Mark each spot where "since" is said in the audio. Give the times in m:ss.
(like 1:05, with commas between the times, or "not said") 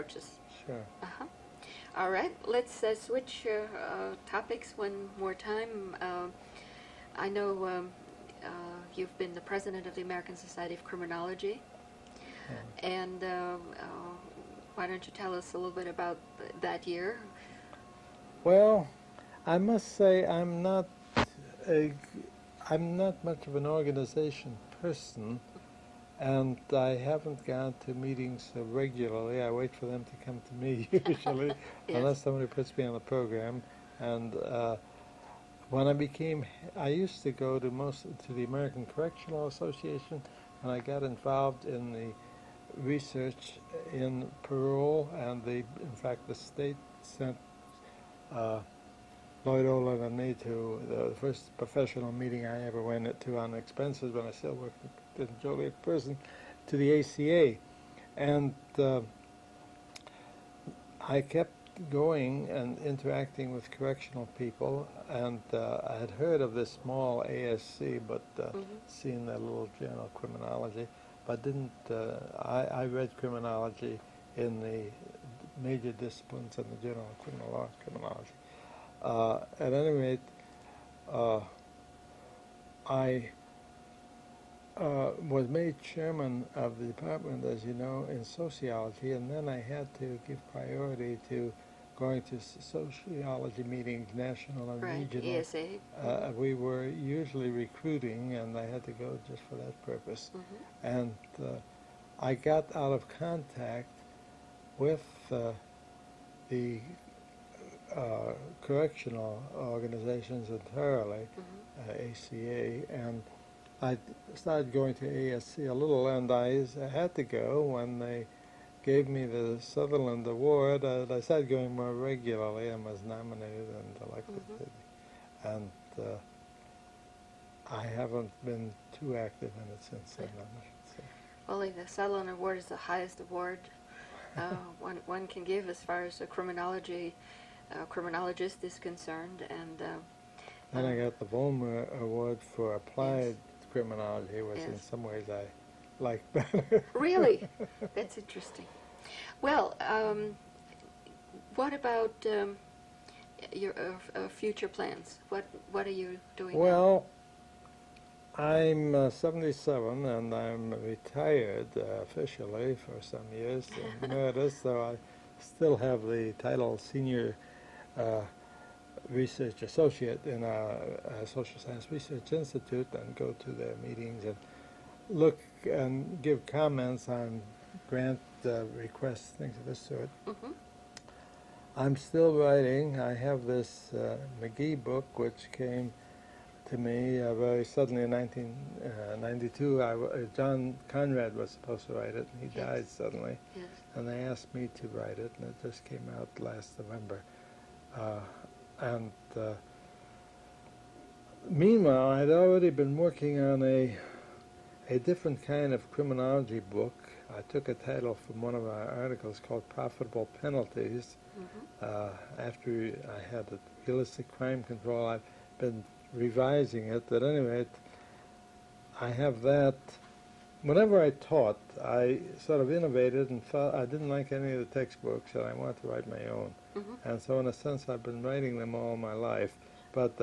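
2:09.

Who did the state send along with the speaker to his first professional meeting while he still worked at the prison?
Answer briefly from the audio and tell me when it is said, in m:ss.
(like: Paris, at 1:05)
Lloyd Ohlin, at 0:49.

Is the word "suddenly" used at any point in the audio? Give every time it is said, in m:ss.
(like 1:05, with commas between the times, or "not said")
3:07, 3:12.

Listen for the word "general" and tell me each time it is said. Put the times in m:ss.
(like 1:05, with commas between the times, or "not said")
1:09, 1:16.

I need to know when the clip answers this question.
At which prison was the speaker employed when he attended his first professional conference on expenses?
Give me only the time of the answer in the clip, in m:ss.
0:55.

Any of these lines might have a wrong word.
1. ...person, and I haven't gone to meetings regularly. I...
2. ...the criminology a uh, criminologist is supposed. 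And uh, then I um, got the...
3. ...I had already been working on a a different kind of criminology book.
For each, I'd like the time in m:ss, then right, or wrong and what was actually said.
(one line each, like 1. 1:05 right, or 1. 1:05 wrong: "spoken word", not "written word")
1. 0:24 right
2. 2:16 wrong: "concerned", not "supposed"
3. 3:22 right.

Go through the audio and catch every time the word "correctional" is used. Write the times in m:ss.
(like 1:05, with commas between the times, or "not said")
0:38, 1:03, 1:48.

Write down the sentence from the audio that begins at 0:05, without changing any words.
Uh, I know um, you've been the president of the American Society of Criminology, oh.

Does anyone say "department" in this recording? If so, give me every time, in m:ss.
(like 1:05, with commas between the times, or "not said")
1:26.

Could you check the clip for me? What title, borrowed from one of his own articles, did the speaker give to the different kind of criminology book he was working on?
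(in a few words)
Profitable Penalties.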